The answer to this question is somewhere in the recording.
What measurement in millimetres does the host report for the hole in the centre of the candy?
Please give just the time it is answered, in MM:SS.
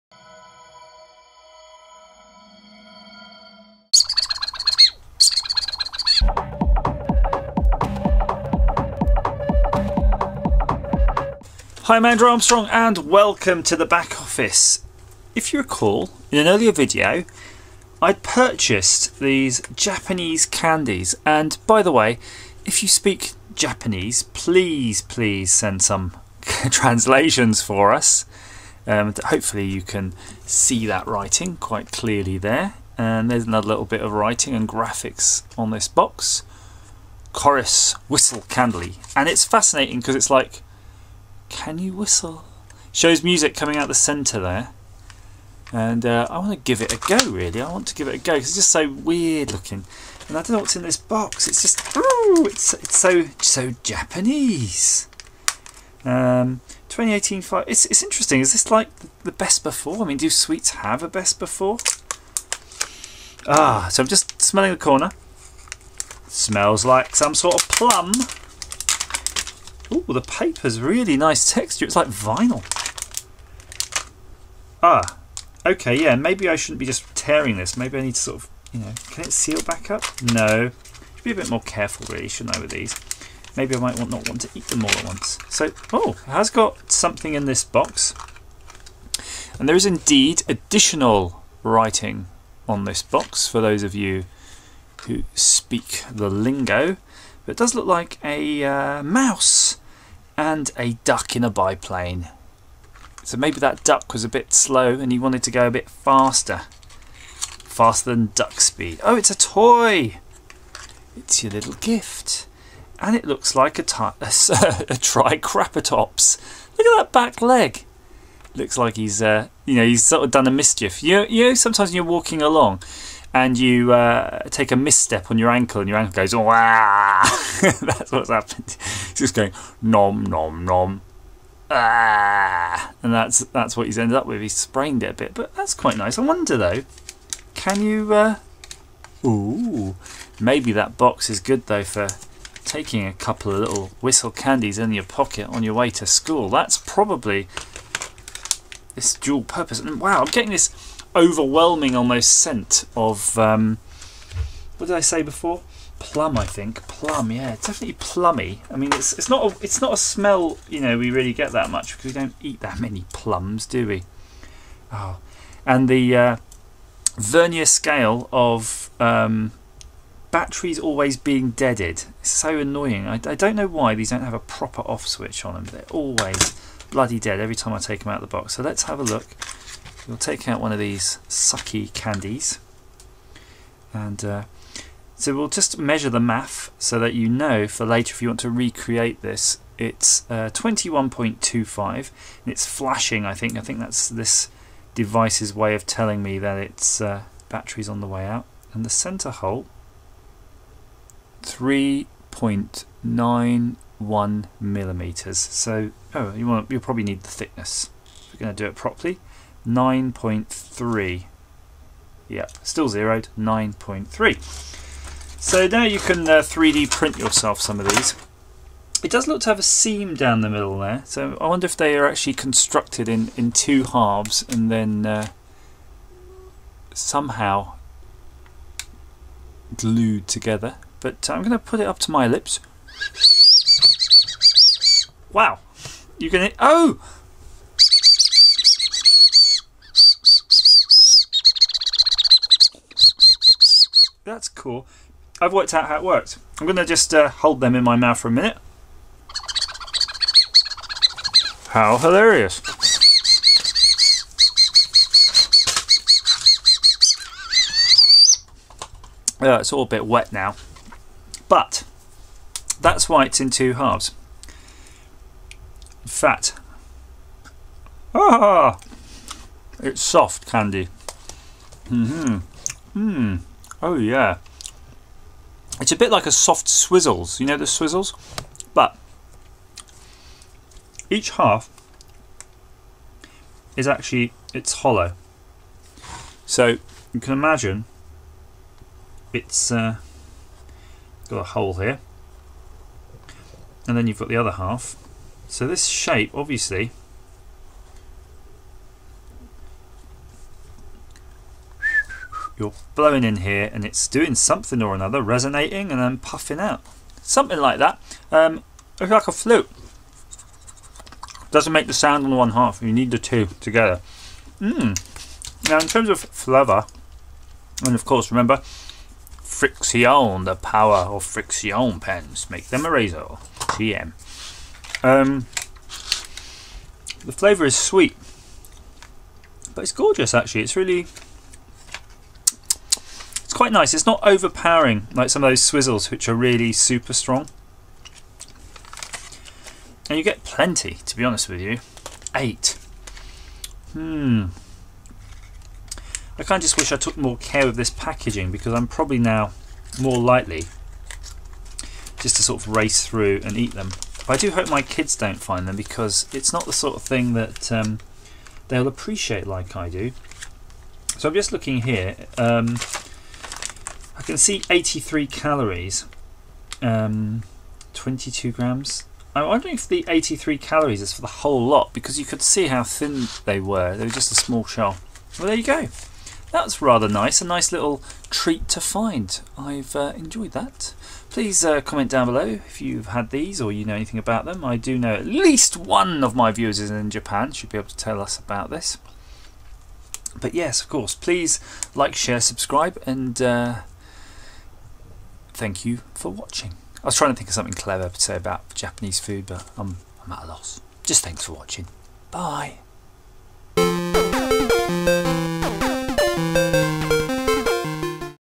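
03:21.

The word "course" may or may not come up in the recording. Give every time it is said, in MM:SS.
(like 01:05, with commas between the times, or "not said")
05:18, 06:30.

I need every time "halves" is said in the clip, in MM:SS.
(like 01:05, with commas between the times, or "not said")
03:43, 04:23.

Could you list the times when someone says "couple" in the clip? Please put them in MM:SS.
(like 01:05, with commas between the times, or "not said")
02:23.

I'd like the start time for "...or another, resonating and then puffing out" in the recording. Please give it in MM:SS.
05:04.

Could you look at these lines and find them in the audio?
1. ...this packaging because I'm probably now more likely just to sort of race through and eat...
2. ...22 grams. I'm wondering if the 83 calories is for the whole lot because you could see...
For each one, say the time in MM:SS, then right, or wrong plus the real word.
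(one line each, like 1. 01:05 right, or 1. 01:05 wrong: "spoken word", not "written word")
1. 05:47 right
2. 06:07 right.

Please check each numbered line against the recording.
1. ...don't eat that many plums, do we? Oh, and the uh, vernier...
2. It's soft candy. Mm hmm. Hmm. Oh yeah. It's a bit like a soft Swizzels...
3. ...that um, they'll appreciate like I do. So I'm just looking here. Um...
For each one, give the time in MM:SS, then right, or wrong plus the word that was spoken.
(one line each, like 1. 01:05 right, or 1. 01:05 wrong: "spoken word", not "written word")
1. 02:42 right
2. 04:29 right
3. 05:57 right.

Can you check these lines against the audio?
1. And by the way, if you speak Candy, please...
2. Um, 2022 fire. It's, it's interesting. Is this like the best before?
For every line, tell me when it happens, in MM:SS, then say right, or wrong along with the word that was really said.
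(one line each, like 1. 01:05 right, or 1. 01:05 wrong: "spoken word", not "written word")
1. 00:21 wrong: "Japanese", not "Candy"
2. 00:56 wrong: "2018", not "2022".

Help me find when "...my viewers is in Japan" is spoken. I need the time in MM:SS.
06:26.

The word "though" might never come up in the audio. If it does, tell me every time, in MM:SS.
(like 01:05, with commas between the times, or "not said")
02:16, 02:21.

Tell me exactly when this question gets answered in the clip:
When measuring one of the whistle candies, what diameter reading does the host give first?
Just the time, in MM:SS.
03:10.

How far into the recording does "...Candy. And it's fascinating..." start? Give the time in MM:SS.
00:38.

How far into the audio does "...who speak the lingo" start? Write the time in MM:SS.
01:35.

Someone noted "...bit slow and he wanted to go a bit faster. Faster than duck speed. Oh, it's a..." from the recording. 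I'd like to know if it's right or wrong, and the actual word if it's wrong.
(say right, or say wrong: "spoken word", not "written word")
right.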